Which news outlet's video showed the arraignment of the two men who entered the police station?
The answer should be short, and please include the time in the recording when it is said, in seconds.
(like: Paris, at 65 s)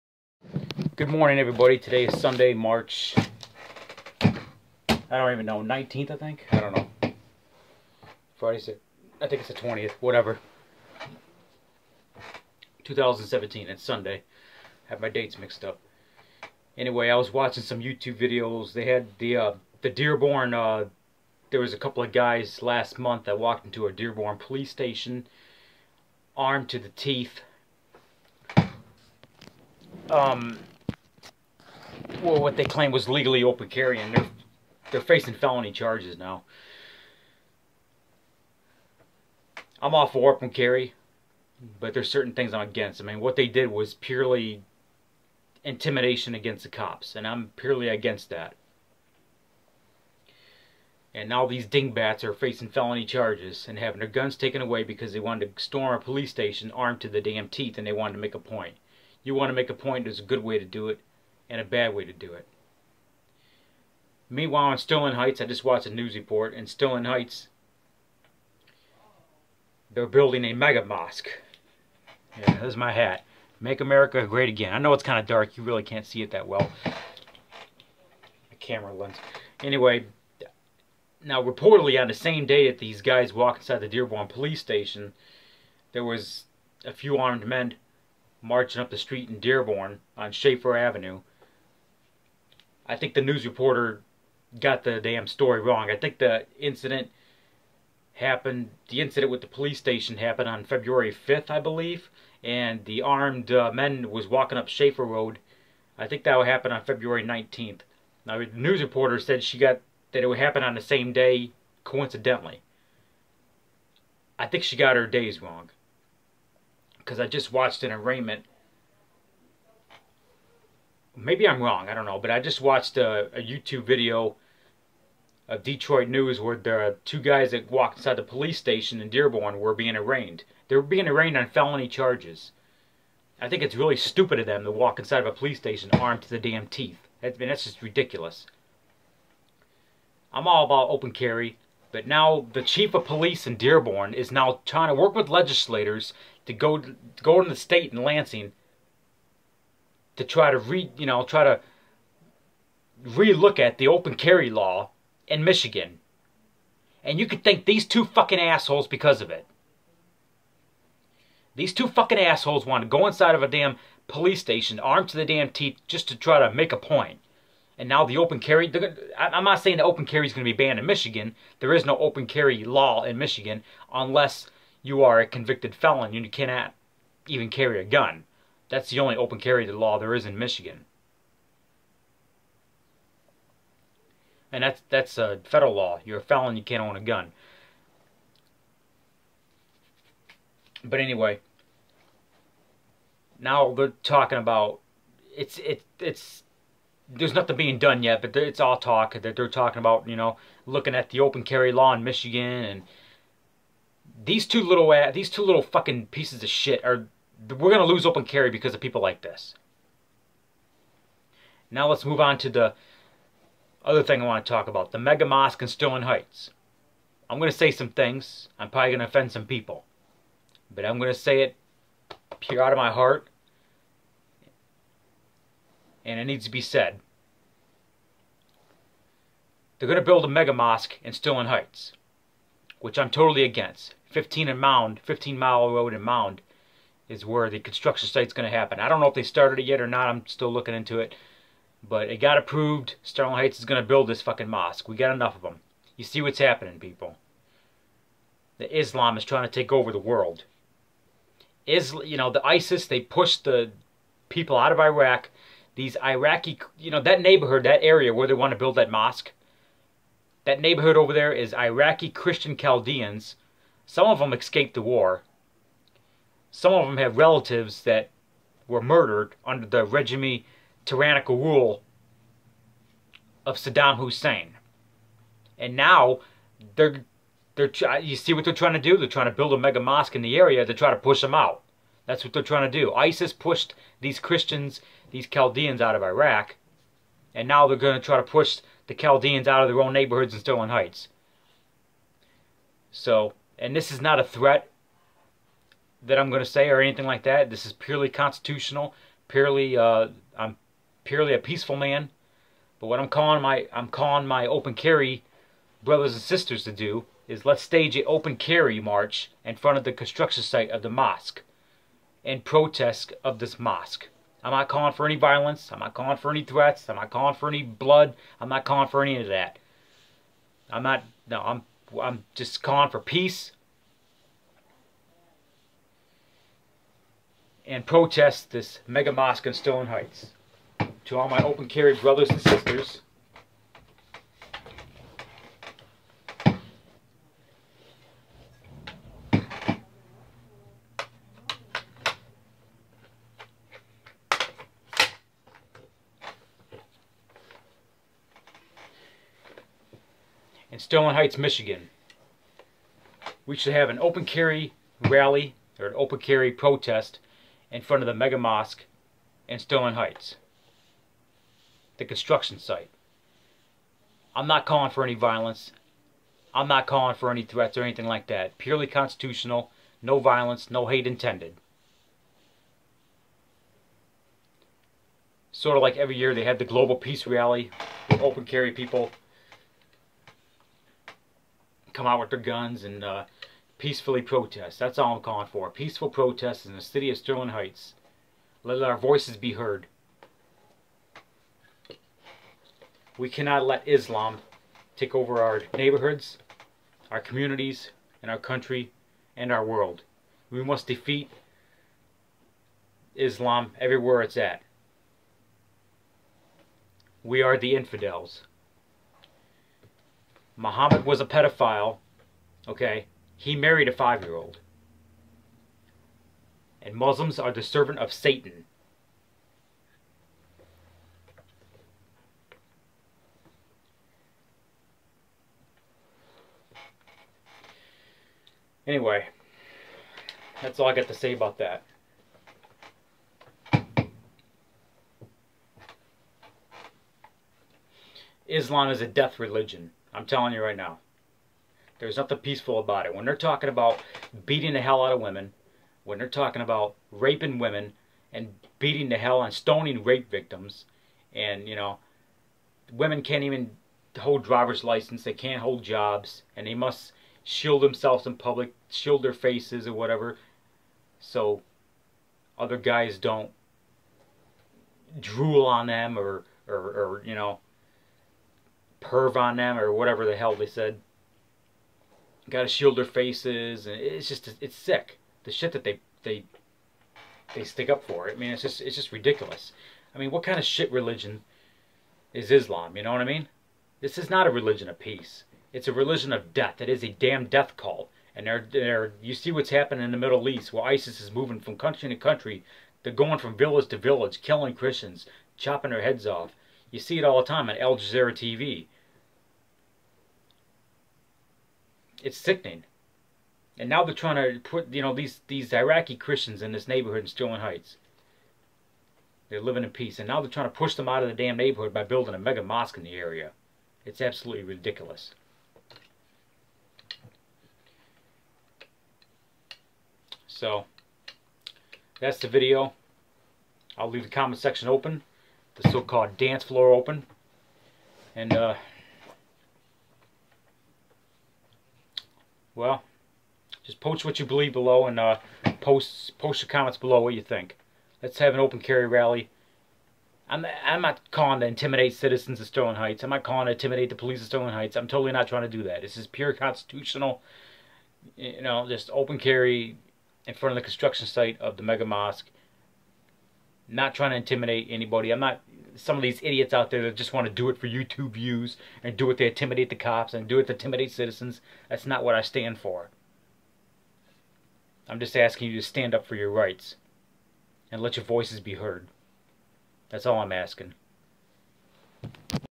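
Detroit News, at 125 s.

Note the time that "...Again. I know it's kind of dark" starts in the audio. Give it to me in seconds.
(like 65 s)
74 s.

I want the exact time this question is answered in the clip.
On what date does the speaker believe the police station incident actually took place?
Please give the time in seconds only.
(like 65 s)
100 s.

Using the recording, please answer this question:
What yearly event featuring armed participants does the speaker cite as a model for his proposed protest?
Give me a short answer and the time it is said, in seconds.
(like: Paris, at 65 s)
Global Peace Rally, at 376 s.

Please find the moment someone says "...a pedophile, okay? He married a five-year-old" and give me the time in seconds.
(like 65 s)
411 s.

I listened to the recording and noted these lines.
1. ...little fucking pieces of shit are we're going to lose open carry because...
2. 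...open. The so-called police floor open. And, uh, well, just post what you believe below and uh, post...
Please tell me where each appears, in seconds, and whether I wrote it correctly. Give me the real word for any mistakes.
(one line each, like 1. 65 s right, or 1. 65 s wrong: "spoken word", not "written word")
1. 205 s right
2. 524 s wrong: "dance", not "police".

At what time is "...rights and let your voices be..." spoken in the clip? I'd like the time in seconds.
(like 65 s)
566 s.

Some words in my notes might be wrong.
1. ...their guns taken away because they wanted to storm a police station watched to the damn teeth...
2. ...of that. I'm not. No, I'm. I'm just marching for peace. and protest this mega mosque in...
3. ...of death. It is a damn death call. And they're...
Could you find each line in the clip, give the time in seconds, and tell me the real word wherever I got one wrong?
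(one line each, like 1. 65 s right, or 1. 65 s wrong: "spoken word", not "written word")
1. 53 s wrong: "armed", not "watched"
2. 319 s wrong: "calling", not "marching"
3. 486 s right.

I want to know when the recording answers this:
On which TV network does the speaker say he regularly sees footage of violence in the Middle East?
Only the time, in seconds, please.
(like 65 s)
497 s.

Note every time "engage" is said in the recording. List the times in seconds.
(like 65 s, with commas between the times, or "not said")
not said.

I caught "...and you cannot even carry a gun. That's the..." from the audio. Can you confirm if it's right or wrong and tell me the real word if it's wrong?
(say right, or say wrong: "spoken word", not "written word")
right.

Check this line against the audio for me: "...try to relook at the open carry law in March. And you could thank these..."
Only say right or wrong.
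wrong.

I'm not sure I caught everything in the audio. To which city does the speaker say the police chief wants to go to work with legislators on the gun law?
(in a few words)
Lansing.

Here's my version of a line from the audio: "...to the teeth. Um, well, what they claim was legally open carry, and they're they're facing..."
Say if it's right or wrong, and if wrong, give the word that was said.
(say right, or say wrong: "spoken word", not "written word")
right.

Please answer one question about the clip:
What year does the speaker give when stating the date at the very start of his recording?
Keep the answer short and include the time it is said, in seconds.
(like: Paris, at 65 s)
2017, at 12 s.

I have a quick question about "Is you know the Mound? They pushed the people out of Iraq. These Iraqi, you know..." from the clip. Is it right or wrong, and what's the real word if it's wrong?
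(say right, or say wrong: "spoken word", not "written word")
wrong: "ISIS", not "Mound".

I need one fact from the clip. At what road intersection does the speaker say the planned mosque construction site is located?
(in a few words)
15 Mile Road and Mound.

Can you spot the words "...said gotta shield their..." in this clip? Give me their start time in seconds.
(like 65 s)
470 s.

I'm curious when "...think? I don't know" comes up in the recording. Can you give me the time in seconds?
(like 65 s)
6 s.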